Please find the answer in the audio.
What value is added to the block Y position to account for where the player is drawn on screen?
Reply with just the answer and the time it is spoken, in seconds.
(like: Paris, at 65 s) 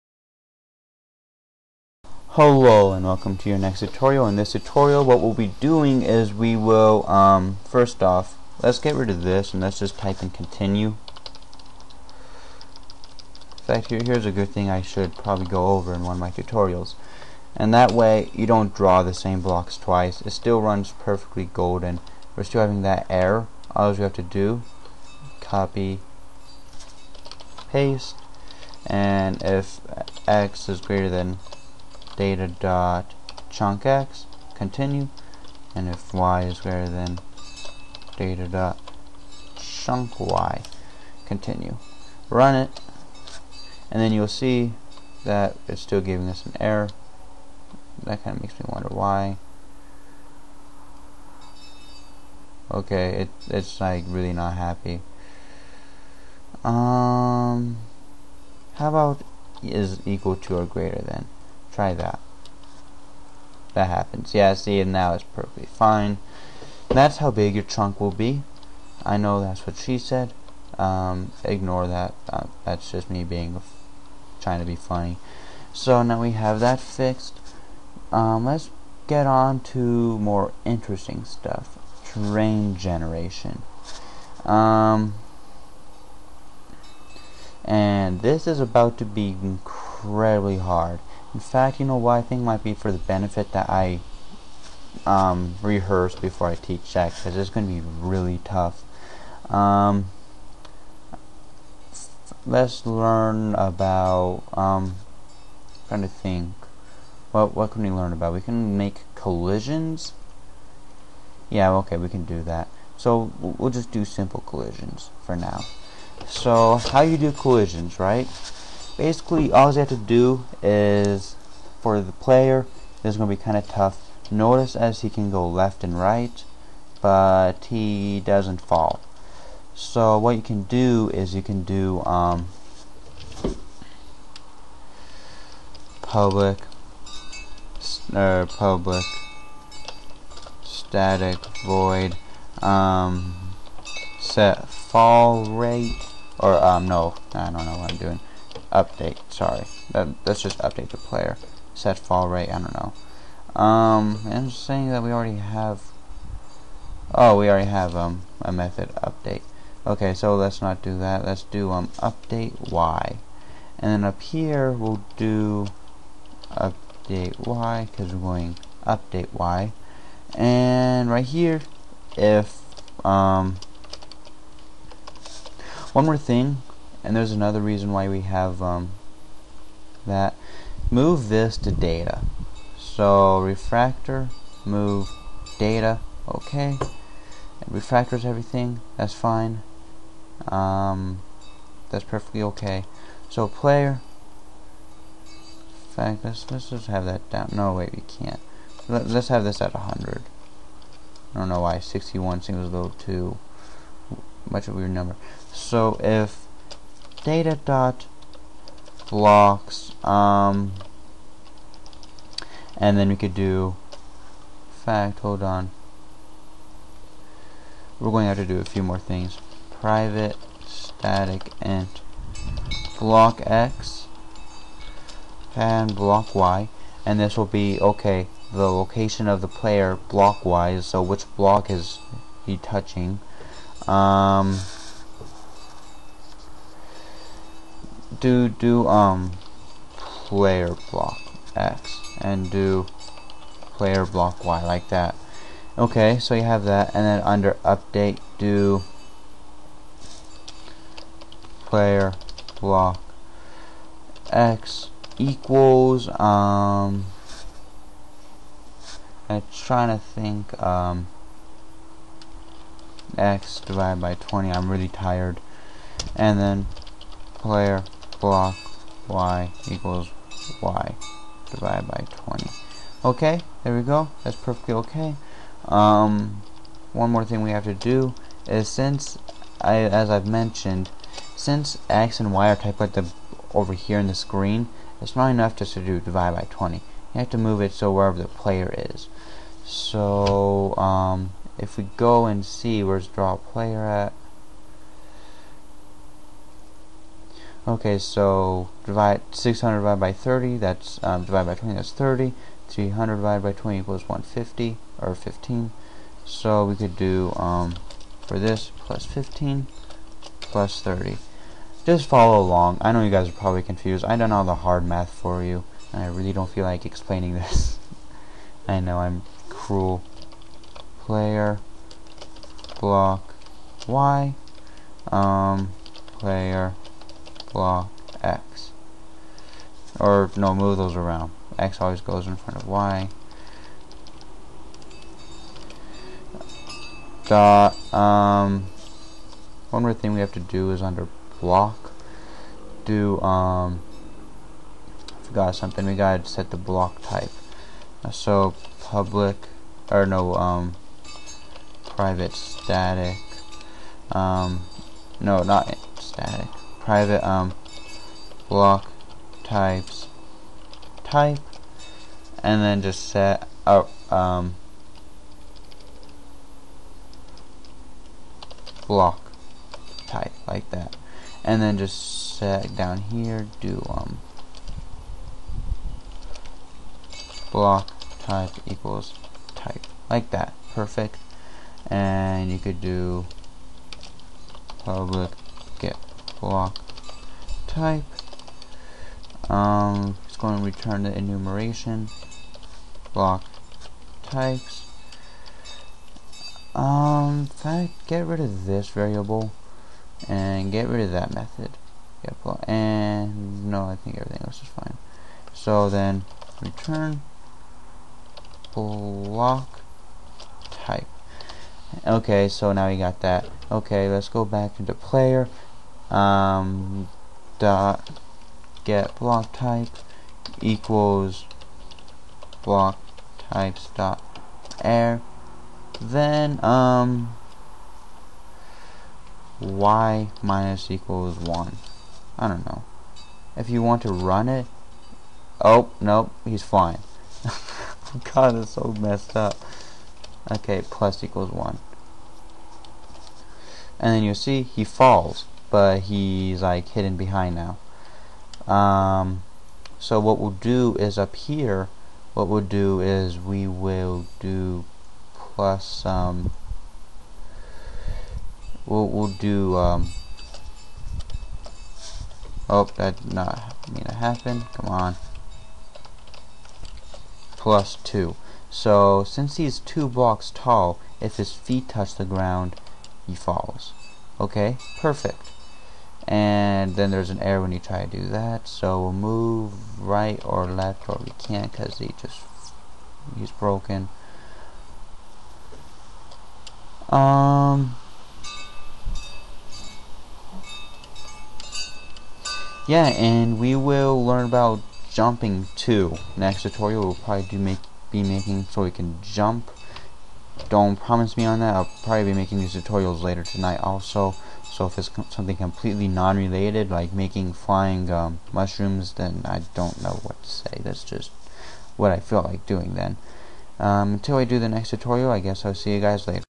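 15, at 308 s.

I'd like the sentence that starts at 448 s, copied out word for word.
Um, so what we'll do is up here, what we'll do is we will do plus some.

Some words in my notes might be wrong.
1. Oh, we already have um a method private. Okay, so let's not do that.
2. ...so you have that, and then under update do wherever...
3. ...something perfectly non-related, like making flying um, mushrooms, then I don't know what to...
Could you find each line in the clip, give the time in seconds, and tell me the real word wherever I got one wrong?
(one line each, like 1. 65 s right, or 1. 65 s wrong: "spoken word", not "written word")
1. 157 s wrong: "update", not "private"
2. 246 s wrong: "player", not "wherever"
3. 505 s wrong: "completely", not "perfectly".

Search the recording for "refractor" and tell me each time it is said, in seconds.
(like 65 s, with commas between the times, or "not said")
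183 s, 187 s.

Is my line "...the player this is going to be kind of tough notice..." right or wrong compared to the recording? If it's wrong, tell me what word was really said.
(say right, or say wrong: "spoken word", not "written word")
right.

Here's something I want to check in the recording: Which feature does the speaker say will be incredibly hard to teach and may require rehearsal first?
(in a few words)
Terrain generation.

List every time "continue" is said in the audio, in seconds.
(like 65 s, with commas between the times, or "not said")
10 s, 34 s, 41 s.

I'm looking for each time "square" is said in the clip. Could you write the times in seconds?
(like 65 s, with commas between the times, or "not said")
not said.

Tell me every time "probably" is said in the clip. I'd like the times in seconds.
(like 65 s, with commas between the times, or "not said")
15 s, 313 s, 497 s, 502 s.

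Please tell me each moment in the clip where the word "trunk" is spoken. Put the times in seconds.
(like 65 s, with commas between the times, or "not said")
67 s.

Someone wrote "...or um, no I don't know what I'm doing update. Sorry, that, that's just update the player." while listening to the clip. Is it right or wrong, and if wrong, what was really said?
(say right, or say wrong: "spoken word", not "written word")
right.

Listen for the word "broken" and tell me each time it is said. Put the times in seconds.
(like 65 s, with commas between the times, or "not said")
483 s.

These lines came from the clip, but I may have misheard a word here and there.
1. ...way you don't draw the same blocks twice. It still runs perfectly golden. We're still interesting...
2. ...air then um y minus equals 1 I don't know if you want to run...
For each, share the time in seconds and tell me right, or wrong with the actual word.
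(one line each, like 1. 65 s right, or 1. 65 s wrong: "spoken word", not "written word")
1. 17 s wrong: "having", not "interesting"
2. 424 s right.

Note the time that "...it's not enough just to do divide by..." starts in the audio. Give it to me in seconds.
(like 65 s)
285 s.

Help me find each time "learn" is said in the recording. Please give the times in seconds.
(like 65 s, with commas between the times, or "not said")
102 s, 107 s, 494 s.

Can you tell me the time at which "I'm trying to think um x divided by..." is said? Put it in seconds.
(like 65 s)
259 s.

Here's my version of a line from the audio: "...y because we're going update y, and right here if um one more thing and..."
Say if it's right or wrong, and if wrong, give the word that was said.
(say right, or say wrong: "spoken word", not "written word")
right.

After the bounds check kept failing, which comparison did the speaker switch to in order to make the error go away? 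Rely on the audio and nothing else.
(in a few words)
equal to or greater than.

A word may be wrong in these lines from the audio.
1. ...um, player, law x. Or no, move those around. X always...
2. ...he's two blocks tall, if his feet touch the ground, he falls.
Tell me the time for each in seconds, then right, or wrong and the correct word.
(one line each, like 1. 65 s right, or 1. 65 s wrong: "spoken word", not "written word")
1. 325 s right
2. 469 s right.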